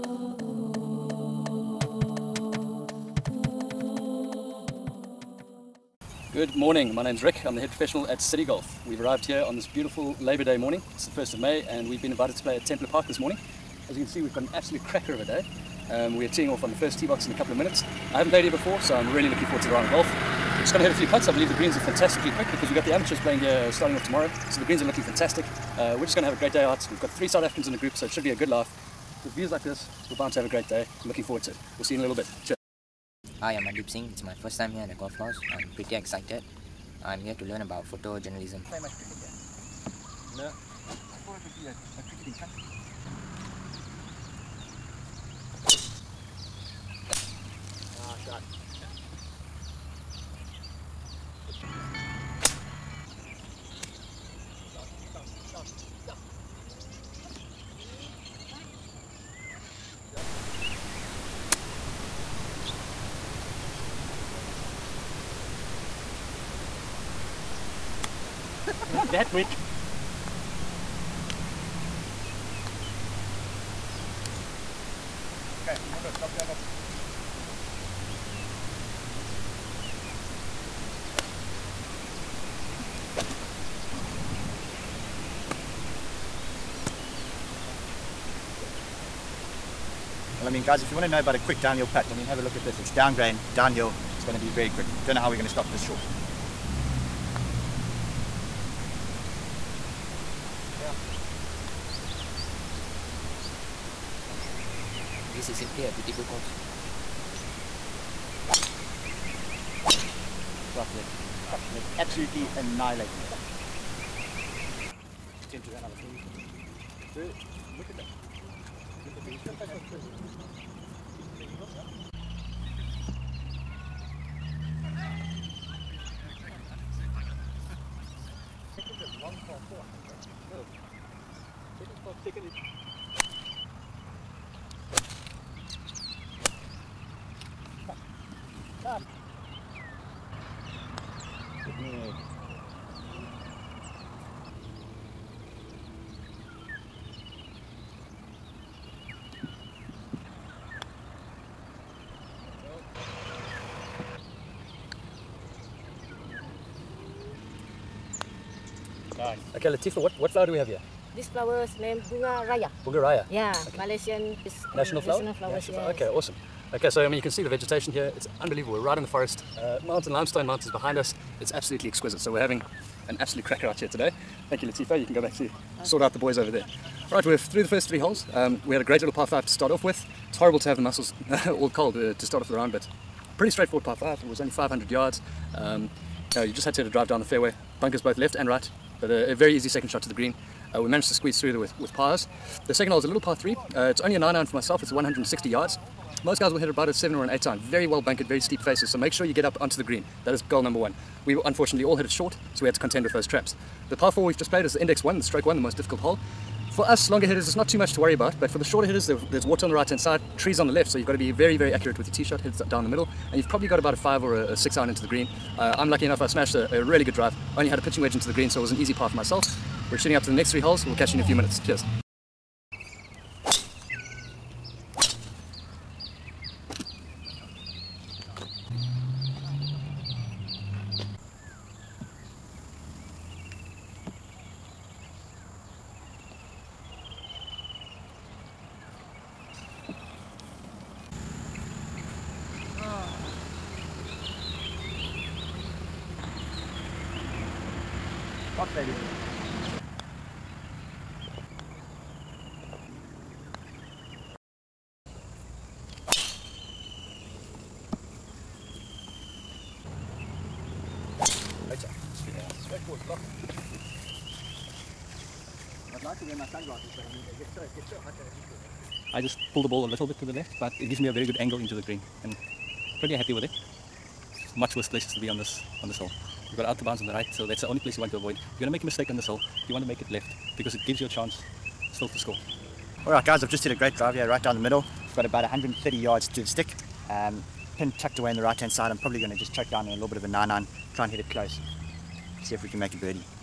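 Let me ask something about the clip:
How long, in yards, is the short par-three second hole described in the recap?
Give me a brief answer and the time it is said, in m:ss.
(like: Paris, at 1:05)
160 yards, at 3:14.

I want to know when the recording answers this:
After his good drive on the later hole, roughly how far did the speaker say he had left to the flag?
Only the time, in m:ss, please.
4:45.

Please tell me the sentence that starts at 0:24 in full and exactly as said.
So the greens are looking fantastic.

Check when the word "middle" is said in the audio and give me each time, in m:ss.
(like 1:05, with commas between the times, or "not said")
3:32, 4:44.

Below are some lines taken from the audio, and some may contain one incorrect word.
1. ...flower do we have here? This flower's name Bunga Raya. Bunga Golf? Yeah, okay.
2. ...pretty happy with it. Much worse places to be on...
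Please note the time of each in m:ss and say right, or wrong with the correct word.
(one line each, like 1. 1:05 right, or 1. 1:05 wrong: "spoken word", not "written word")
1. 2:40 wrong: "Raya", not "Golf"
2. 4:33 right.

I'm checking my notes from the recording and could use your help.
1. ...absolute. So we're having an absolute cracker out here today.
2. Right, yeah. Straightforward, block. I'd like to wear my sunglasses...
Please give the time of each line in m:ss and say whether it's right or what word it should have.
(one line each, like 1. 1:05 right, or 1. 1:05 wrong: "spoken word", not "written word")
1. 2:51 wrong: "exquisite", not "absolute"
2. 4:21 right.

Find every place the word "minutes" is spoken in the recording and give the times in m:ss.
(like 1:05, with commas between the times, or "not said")
0:17, 3:41.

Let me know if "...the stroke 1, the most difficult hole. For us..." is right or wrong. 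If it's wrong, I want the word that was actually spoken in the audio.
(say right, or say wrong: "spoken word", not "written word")
right.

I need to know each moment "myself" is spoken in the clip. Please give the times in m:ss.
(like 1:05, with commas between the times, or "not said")
3:14, 3:39.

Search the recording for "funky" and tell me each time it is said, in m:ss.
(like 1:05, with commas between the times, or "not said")
not said.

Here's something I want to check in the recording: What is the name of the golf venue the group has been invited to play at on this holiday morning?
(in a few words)
Templer Park.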